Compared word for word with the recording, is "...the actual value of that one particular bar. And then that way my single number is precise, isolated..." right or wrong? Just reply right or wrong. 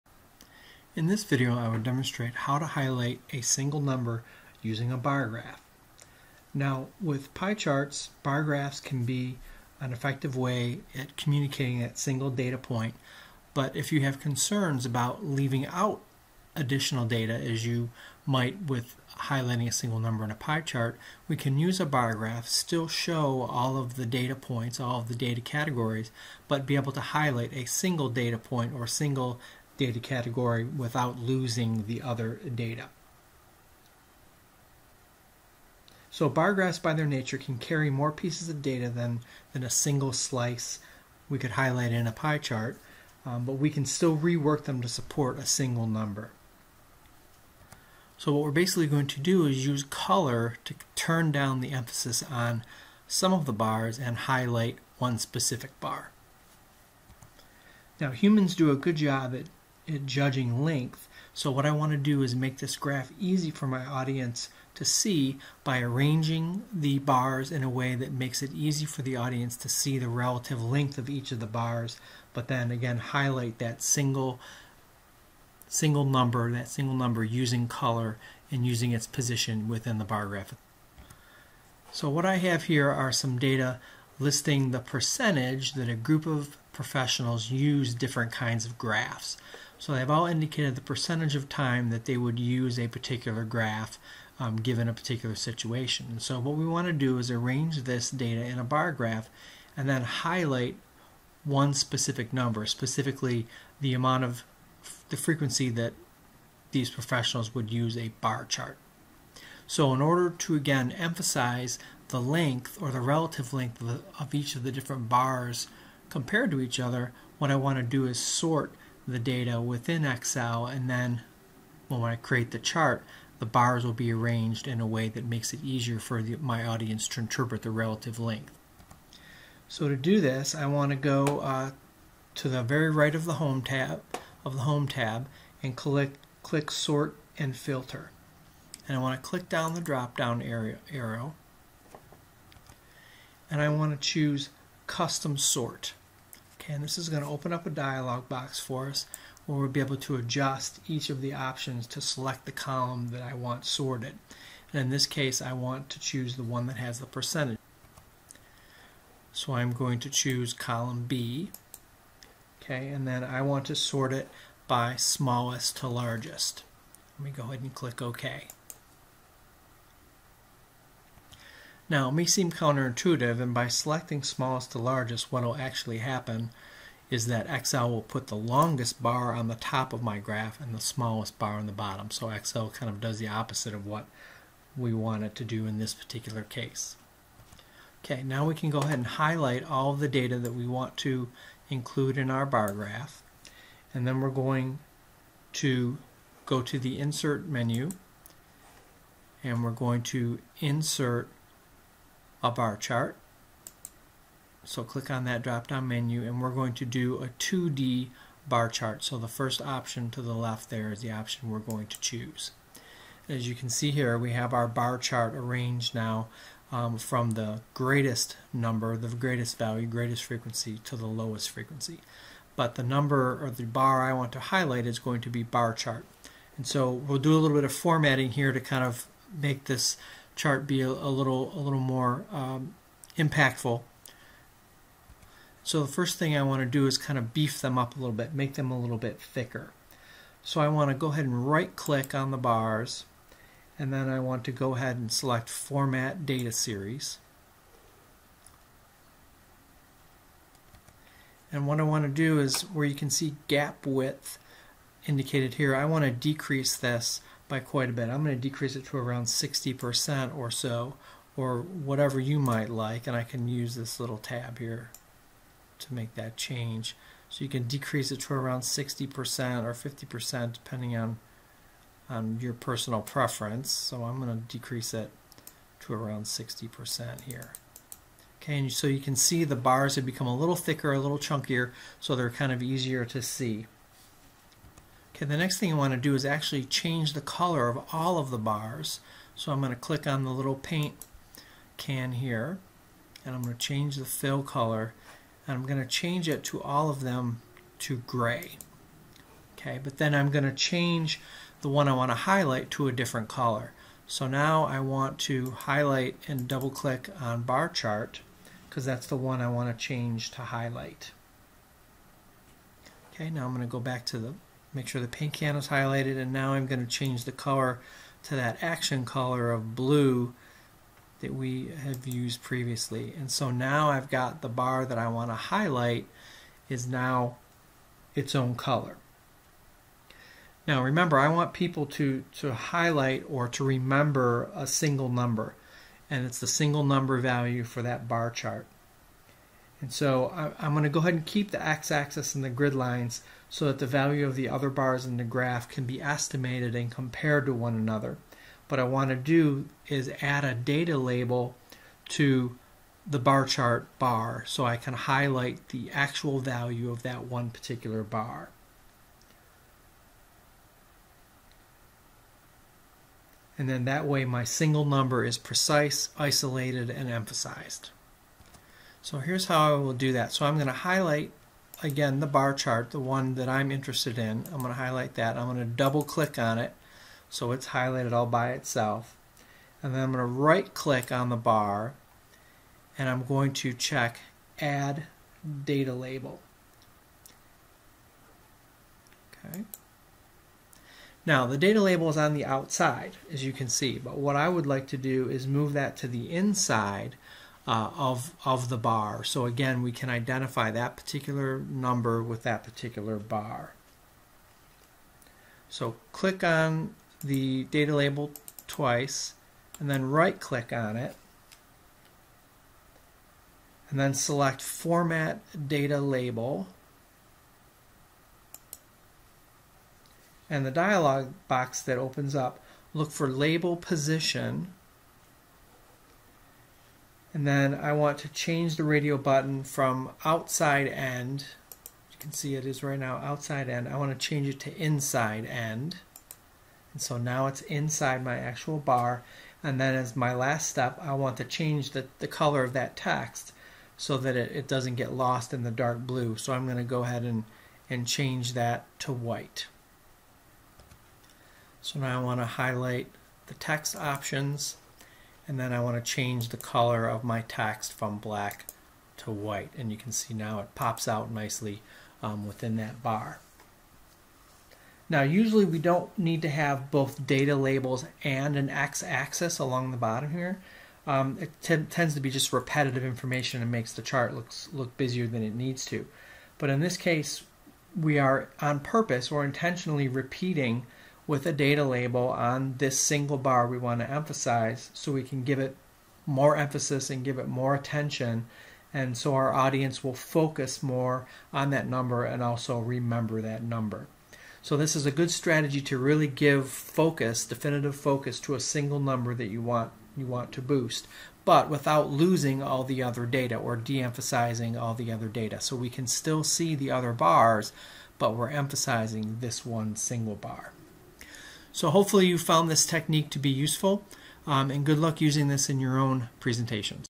right.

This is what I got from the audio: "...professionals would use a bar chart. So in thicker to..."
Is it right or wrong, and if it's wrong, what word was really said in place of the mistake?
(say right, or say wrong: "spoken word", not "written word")
wrong: "order", not "thicker".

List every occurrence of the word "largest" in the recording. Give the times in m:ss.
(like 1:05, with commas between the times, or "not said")
2:45, 2:54.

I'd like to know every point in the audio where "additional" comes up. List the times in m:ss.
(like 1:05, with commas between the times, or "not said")
0:16.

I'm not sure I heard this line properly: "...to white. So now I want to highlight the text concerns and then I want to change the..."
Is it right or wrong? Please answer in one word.
wrong.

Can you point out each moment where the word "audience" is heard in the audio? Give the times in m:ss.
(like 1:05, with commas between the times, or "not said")
1:03, 1:09, 2:06, 8:09.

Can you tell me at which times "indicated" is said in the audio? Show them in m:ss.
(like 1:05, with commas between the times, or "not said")
1:30, 4:15.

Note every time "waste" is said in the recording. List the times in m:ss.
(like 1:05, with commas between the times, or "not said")
not said.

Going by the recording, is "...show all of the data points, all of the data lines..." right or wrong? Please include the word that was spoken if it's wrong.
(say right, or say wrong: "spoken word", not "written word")
wrong: "categories", not "lines".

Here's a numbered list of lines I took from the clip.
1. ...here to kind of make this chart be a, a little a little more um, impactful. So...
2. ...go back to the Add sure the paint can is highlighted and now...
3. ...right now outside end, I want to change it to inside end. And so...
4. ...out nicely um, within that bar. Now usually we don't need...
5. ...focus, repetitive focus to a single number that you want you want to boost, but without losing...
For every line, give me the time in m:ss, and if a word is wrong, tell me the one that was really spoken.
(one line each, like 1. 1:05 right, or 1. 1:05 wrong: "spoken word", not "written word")
1. 3:48 right
2. 5:13 wrong: "Make", not "Add"
3. 7:12 right
4. 7:41 right
5. 8:16 wrong: "definitive", not "repetitive".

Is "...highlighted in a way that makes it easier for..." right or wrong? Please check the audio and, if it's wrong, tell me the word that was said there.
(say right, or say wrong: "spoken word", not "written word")
wrong: "arranged", not "highlighted".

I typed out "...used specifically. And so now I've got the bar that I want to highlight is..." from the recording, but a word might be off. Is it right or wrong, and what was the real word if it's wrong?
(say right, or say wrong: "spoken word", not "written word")
wrong: "previously", not "specifically".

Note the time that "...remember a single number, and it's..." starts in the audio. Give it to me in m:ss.
5:33.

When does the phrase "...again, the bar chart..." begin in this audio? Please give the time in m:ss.
6:11.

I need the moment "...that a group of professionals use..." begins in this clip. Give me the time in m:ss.
1:25.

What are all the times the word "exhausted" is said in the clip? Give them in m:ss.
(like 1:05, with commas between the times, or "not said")
not said.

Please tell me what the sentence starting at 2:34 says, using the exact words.
And in this case, I want to choose the one that has the percentage.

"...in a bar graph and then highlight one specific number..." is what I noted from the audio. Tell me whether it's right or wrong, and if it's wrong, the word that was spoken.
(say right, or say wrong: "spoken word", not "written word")
right.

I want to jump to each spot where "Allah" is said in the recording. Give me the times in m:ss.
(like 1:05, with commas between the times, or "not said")
not said.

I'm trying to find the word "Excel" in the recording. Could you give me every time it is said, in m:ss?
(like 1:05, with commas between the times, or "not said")
2:00, 2:57, 3:02.